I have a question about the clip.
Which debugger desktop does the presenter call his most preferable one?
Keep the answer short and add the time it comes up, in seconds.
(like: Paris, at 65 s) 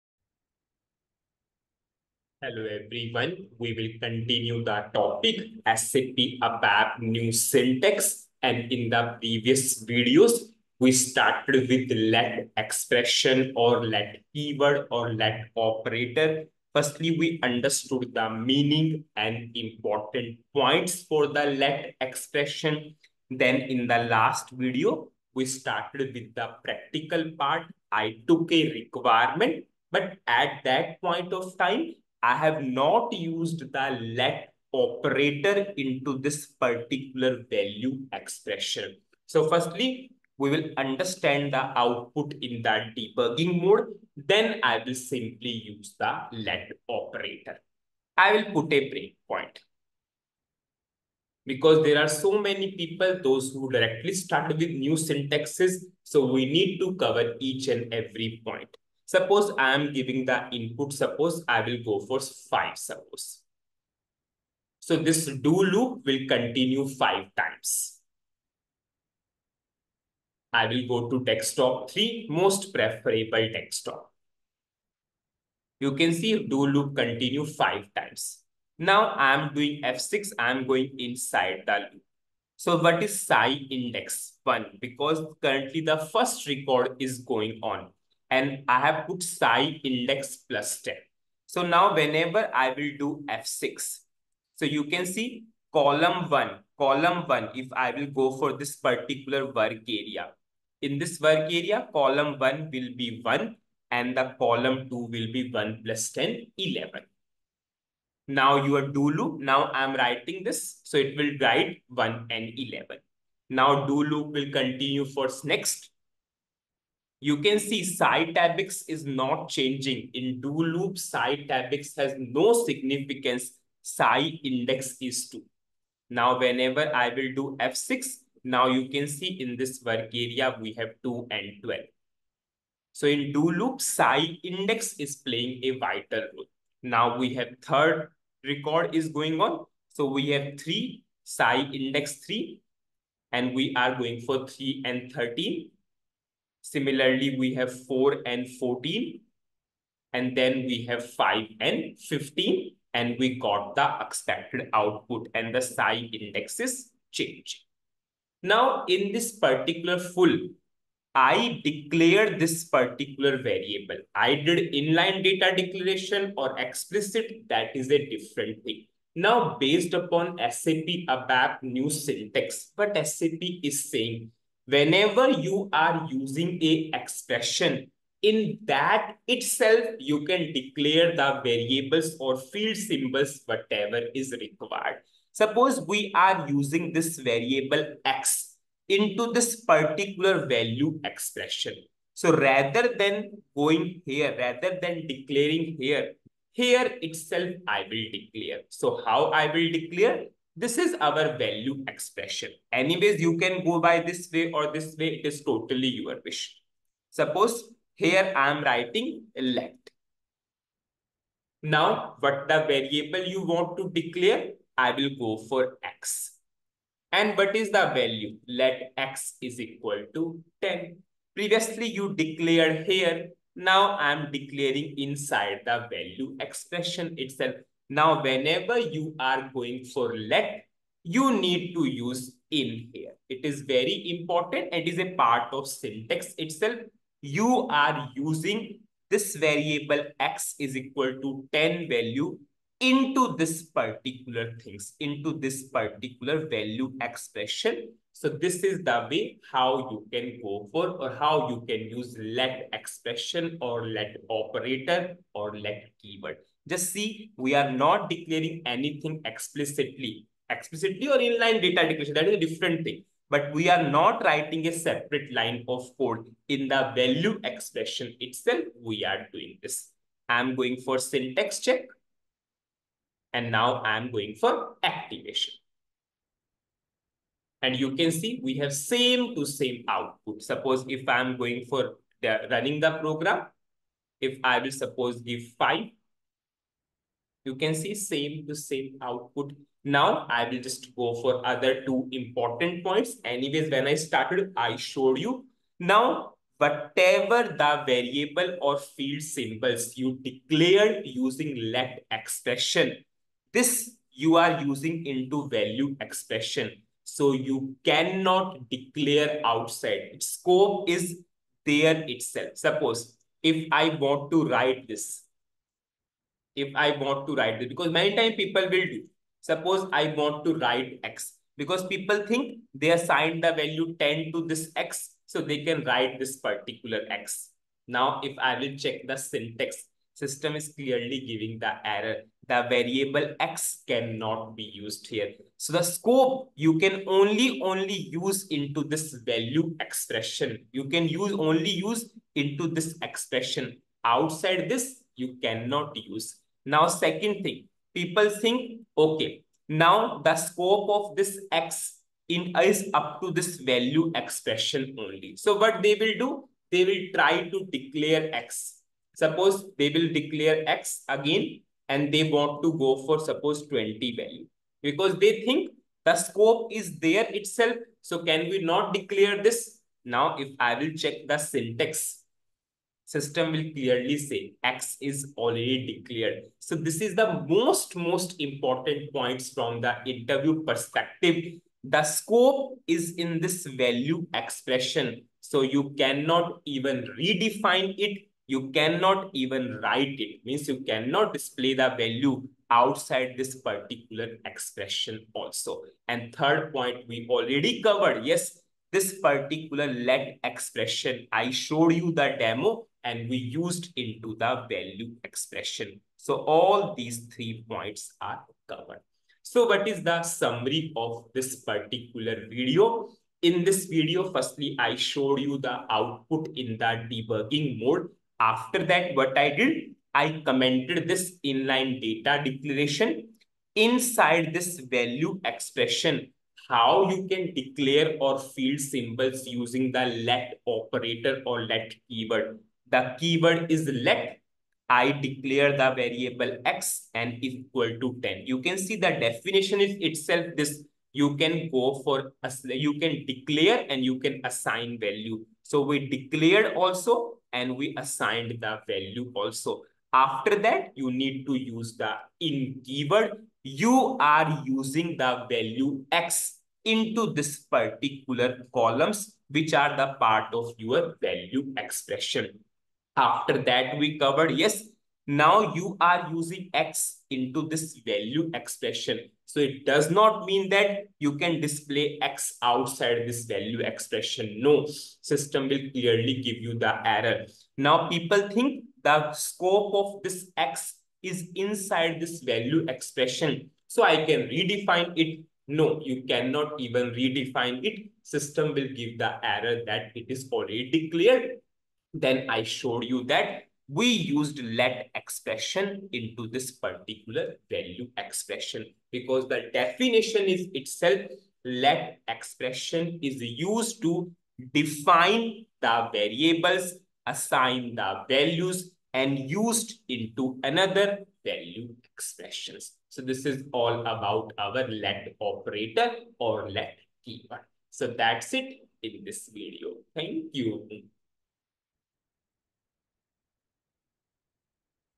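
Desktop 3, at 71 s.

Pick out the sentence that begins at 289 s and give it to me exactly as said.
Now I will just go for other two important points.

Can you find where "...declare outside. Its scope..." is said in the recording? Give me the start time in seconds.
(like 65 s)
308 s.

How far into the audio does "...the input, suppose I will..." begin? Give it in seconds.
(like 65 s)
60 s.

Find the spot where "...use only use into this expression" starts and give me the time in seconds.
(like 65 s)
341 s.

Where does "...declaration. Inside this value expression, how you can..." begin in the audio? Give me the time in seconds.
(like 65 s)
422 s.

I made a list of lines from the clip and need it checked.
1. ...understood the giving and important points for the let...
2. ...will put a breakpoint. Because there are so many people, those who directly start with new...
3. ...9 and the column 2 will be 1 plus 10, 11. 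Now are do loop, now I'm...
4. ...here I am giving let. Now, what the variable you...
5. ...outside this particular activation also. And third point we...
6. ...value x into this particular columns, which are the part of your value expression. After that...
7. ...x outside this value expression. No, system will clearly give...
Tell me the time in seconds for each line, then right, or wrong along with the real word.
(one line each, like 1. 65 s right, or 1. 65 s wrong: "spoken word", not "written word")
1. 17 s wrong: "meaning", not "giving"
2. 48 s right
3. 103 s wrong: "1", not "9"
4. 207 s wrong: "writing", not "giving"
5. 392 s wrong: "expression", not "activation"
6. 455 s right
7. 472 s right.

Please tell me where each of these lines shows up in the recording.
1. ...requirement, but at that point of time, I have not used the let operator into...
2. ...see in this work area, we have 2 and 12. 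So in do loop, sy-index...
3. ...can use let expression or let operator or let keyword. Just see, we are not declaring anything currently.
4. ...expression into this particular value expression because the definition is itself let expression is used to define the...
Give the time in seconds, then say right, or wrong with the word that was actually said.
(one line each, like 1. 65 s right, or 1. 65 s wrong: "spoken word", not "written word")
1. 28 s right
2. 129 s right
3. 251 s wrong: "explicitly", not "currently"
4. 495 s right.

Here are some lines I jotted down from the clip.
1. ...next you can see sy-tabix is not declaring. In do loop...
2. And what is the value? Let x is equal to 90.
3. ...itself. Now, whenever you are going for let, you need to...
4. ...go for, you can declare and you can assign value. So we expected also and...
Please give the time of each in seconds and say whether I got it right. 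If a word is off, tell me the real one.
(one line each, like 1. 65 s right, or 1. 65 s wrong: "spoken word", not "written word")
1. 115 s wrong: "changing", not "declaring"
2. 217 s wrong: "10", not "90"
3. 227 s right
4. 441 s wrong: "declared", not "expected".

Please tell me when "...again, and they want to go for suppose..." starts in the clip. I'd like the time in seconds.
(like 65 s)
361 s.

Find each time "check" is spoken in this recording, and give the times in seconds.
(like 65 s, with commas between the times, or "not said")
271 s, 328 s, 371 s.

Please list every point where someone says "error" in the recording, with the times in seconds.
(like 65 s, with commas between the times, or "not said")
331 s, 477 s, 489 s.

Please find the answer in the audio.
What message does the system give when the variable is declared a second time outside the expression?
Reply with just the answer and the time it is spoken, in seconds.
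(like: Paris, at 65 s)
X is already declared, at 374 s.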